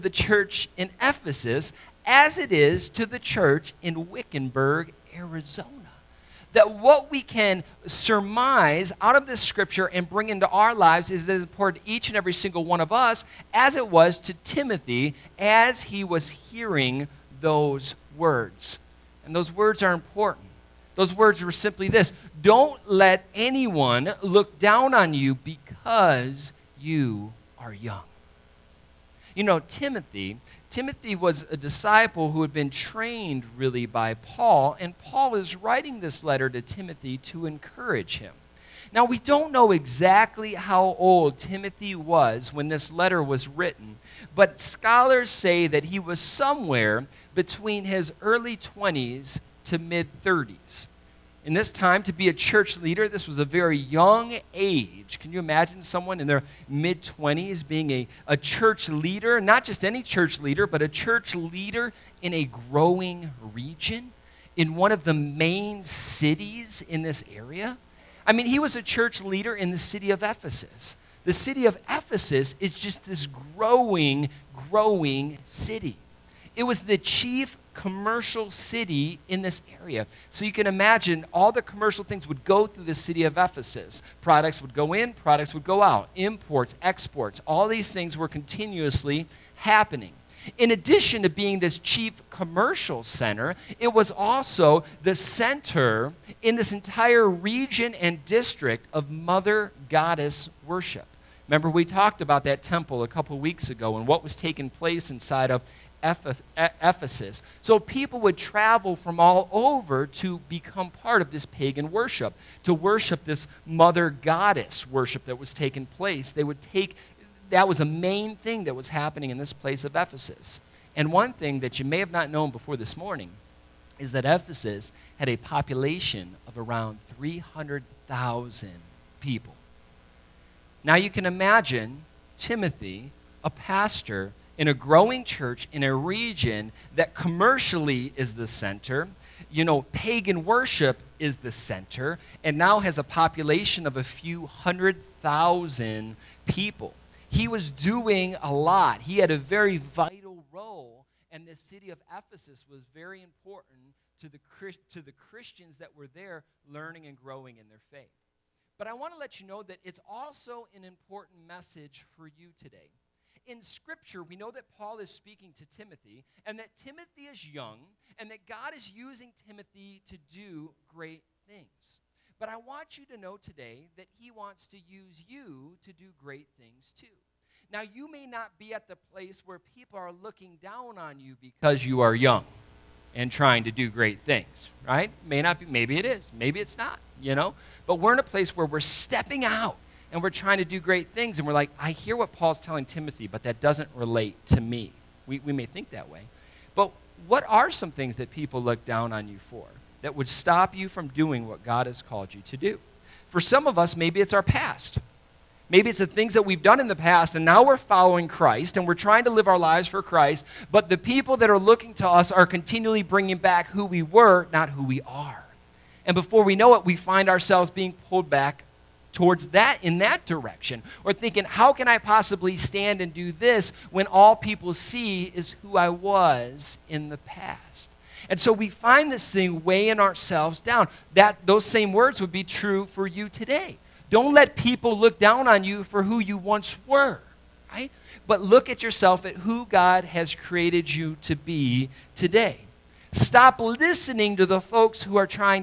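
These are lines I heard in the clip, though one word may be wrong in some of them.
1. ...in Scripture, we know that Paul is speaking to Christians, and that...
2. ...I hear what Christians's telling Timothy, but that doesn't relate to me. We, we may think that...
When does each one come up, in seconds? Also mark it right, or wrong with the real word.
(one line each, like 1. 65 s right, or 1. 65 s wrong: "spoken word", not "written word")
1. 163 s wrong: "Timothy", not "Christians"
2. 191 s wrong: "Paul", not "Christians".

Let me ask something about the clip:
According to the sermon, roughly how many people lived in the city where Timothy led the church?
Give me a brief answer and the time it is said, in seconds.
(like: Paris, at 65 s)
300,000, at 127 s.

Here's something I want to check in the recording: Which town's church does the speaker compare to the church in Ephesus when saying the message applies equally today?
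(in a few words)
Wickenburg, Arizona.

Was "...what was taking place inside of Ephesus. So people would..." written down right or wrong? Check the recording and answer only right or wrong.
right.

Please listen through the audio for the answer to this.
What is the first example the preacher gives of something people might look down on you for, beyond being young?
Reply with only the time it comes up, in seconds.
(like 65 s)
204 s.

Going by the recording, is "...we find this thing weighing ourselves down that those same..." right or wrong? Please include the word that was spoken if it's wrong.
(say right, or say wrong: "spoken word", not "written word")
right.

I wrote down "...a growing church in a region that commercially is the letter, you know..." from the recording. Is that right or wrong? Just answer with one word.
wrong.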